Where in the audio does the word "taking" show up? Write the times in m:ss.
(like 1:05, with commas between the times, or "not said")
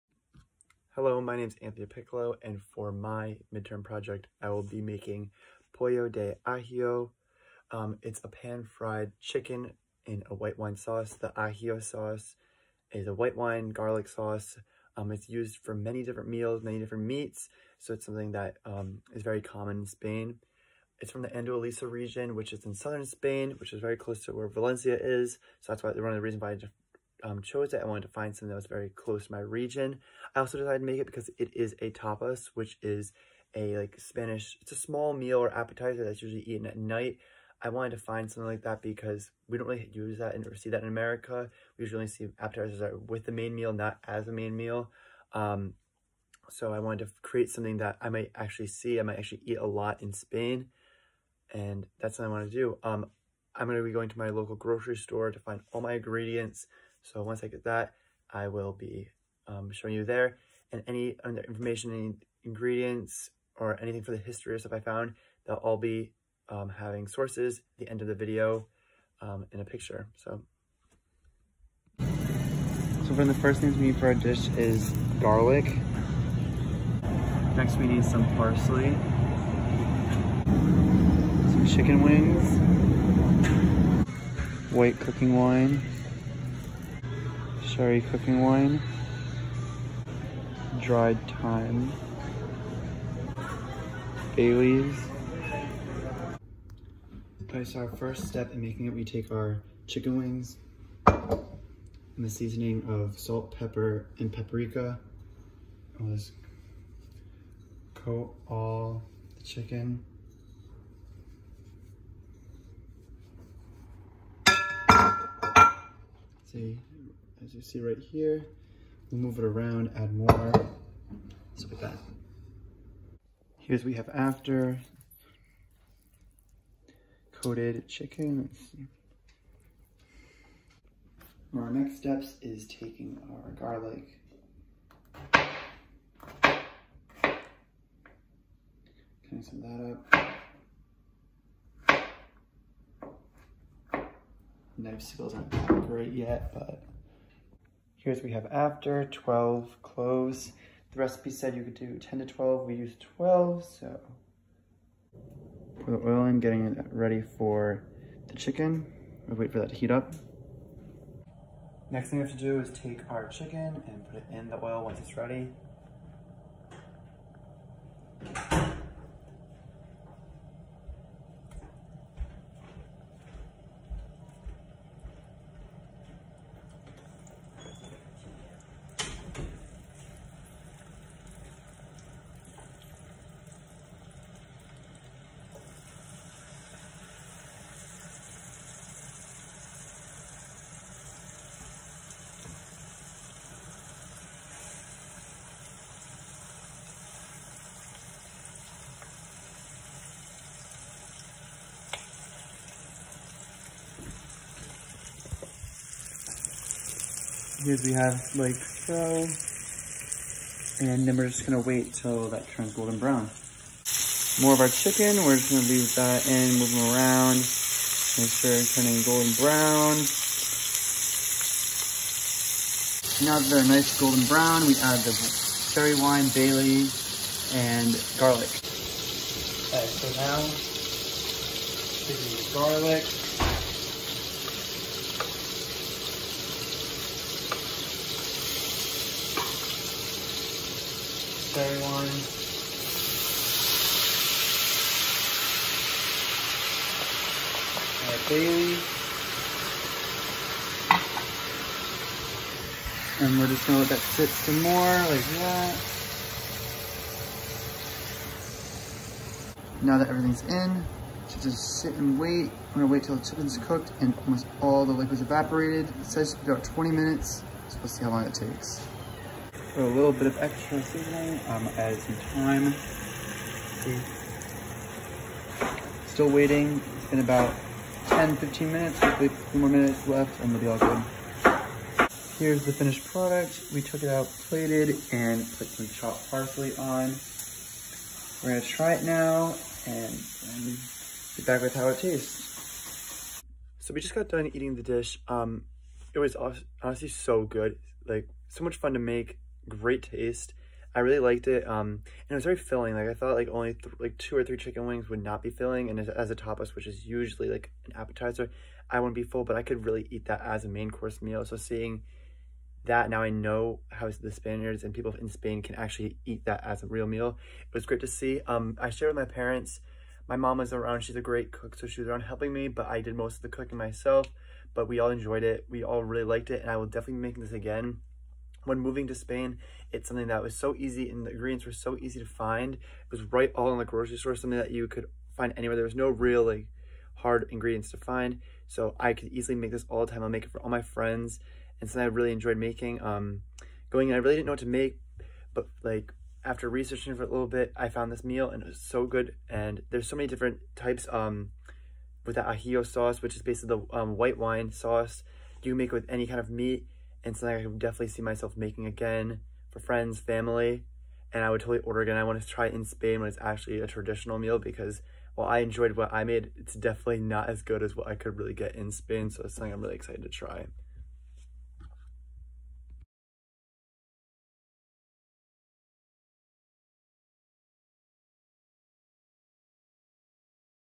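2:12.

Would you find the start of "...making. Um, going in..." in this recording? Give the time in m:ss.
5:42.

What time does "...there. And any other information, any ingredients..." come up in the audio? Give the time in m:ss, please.
1:00.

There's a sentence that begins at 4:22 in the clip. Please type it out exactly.
We're gonna wait till the chicken's cooked and almost all the liquid's evaporated.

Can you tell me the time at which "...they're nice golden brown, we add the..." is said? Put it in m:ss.
3:43.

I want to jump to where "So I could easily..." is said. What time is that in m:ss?
5:38.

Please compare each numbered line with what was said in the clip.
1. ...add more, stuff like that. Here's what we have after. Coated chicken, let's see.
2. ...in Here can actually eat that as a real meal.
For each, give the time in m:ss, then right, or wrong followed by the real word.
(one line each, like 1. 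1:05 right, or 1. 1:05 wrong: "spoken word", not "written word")
1. 1:59 right
2. 5:15 wrong: "Spain", not "Here".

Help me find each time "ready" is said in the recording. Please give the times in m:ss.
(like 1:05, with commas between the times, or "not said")
2:36, 2:45.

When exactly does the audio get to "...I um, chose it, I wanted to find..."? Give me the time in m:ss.
0:26.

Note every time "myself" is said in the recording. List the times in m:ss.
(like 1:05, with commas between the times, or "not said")
5:23, 5:58.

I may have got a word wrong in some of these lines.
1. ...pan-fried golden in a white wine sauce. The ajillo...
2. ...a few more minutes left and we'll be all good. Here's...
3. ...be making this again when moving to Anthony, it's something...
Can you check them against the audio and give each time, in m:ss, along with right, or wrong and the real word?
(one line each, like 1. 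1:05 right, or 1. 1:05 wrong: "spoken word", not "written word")
1. 0:08 wrong: "chicken", not "golden"
2. 4:39 right
3. 5:27 wrong: "Spain", not "Anthony".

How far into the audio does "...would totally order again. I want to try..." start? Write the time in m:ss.
6:01.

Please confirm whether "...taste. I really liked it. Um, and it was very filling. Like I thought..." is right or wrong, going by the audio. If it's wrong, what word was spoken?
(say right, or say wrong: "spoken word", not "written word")
right.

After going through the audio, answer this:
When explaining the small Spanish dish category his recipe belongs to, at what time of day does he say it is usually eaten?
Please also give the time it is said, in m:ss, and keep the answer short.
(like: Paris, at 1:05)
At night, at 0:36.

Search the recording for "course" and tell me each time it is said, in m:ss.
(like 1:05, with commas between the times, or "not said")
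5:10.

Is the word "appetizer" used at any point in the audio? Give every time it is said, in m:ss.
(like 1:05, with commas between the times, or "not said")
0:35, 0:42, 5:07.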